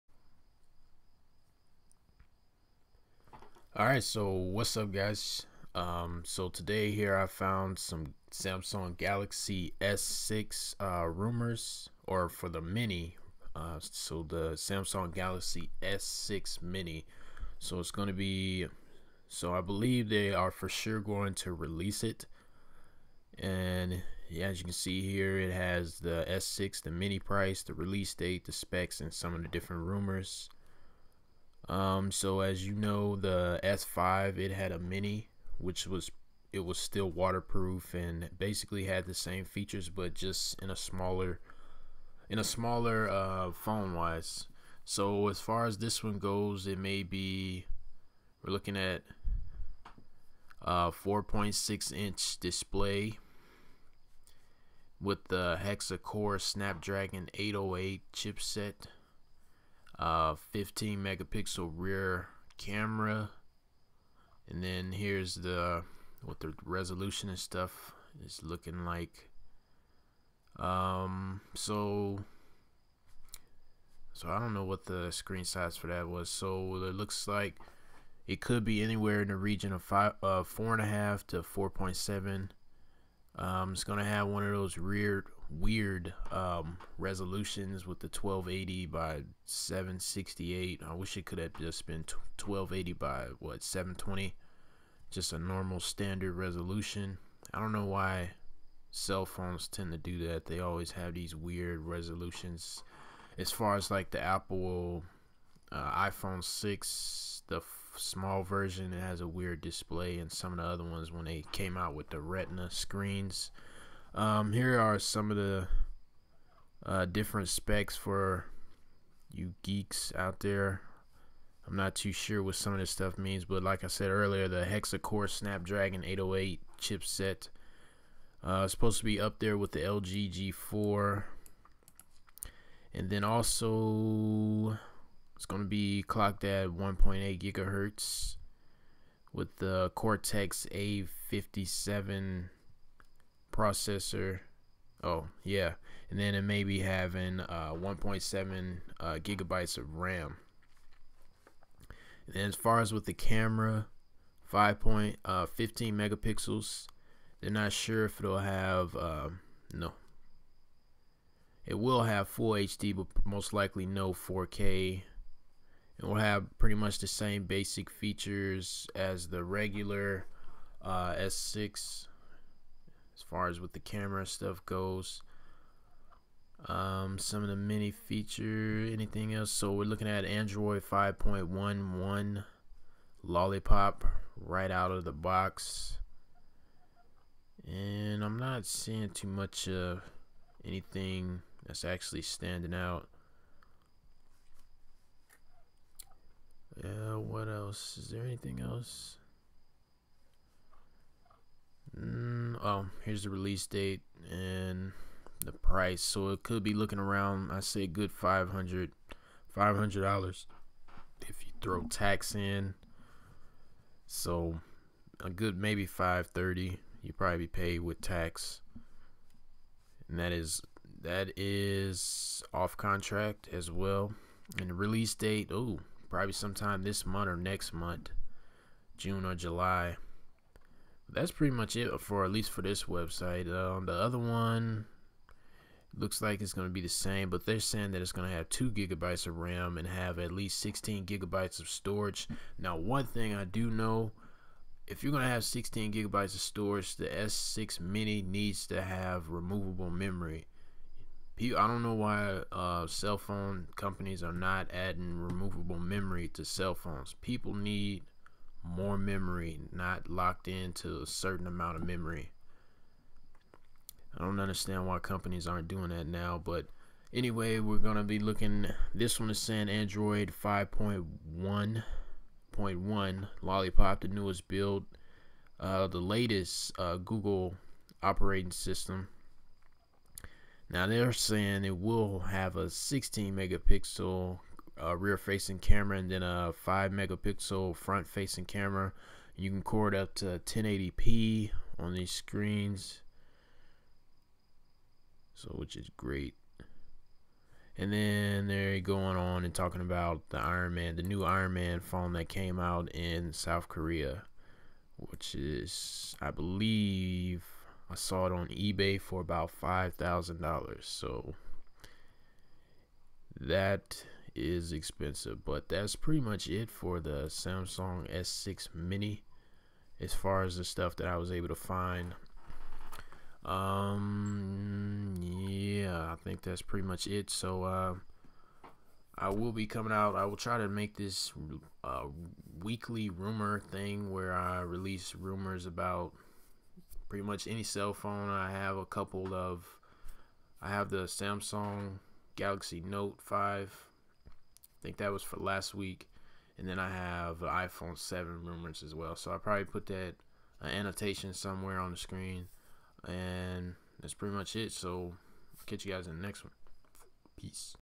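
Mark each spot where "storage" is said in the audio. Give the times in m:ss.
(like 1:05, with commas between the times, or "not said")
4:01, 4:06.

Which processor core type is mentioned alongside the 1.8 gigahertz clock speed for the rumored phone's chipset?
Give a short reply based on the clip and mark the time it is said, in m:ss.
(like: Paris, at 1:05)
Cortex A57, at 2:19.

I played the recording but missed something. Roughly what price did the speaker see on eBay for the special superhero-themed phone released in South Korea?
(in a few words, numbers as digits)
$5,000.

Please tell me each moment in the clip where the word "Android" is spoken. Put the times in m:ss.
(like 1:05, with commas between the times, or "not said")
3:00, 4:29.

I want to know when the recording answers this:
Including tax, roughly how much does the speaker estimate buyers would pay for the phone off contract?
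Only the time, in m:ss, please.
3:35.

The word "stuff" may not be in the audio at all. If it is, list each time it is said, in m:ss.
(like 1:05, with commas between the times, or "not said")
1:07, 2:02, 2:54, 5:20.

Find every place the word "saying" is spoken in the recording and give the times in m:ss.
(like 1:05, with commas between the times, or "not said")
3:57, 4:29, 4:41.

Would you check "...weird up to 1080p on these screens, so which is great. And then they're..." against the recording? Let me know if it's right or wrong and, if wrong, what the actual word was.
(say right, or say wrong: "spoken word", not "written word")
wrong: "record", not "weird".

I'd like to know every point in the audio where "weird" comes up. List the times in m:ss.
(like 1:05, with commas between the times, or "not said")
1:25, 1:41, 1:49.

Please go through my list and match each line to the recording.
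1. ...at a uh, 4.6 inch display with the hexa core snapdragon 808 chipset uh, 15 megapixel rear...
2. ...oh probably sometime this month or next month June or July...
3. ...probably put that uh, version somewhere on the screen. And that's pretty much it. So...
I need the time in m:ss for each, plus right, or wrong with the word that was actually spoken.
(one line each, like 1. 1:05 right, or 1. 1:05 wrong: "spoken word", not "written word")
1. 0:48 right
2. 3:45 right
3. 5:49 wrong: "annotation", not "version".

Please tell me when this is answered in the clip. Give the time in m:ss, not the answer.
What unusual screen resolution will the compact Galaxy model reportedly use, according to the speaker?
1:28.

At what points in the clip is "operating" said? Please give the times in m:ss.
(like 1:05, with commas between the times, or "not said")
4:38.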